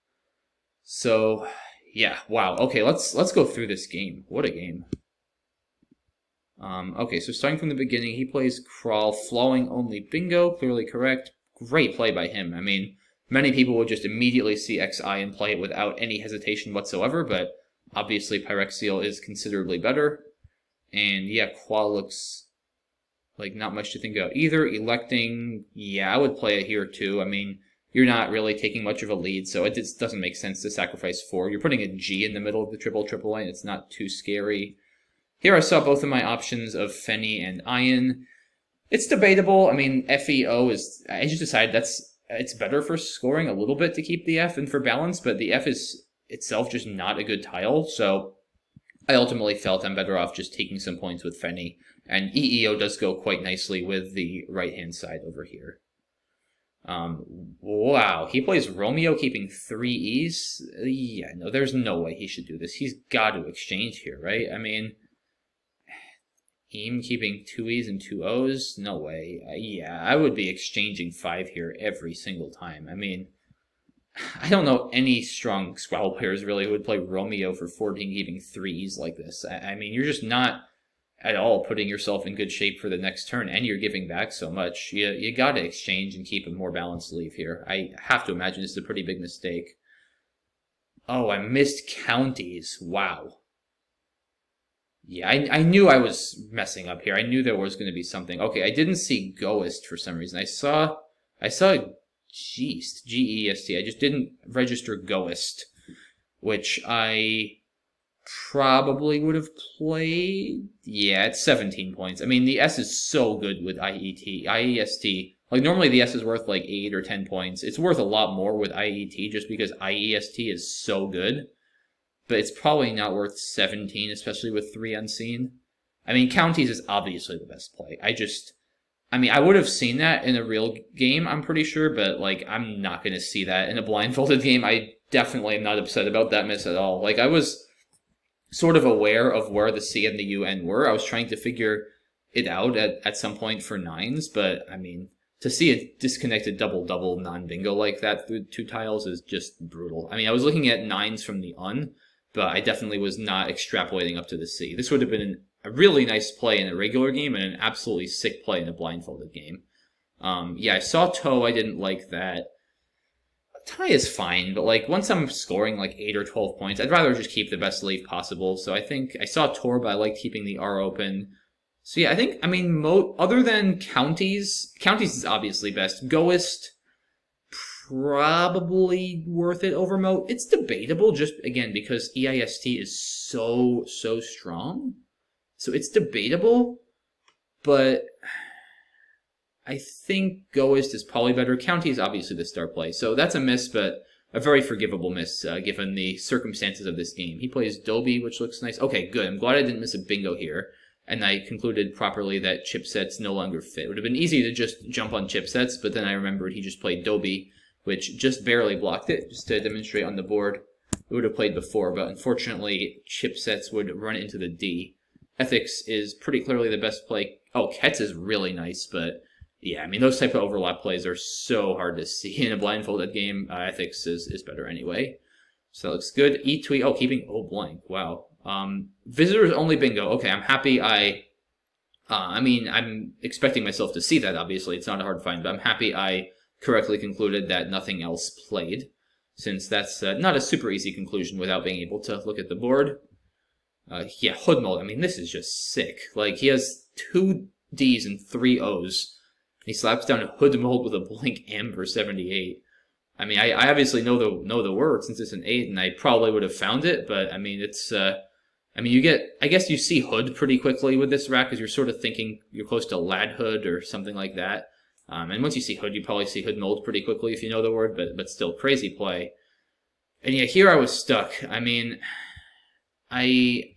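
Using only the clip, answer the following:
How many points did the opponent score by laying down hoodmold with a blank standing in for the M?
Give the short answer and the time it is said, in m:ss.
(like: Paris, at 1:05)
78, at 4:11.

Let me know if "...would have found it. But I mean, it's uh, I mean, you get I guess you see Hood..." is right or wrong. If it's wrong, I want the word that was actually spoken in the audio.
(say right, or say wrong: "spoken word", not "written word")
right.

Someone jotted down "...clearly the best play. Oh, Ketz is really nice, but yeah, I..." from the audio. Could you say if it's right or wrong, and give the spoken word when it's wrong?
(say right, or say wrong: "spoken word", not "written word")
right.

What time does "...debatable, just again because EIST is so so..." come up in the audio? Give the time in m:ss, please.
3:00.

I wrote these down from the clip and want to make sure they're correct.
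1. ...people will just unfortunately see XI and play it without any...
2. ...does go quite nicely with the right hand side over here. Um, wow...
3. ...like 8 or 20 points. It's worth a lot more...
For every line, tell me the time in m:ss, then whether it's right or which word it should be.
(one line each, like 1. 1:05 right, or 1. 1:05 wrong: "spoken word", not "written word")
1. 0:13 wrong: "immediately", not "unfortunately"
2. 0:52 right
3. 1:56 wrong: "10", not "20".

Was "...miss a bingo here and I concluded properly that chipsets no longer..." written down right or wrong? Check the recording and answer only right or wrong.
right.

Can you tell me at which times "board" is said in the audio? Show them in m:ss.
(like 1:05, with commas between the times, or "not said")
3:30, 4:02.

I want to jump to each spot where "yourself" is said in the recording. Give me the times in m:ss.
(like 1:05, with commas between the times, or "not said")
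1:21.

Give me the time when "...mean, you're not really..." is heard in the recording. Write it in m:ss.
0:27.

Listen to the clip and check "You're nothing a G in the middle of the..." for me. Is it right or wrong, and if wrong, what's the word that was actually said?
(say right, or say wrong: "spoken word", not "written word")
wrong: "putting", not "nothing".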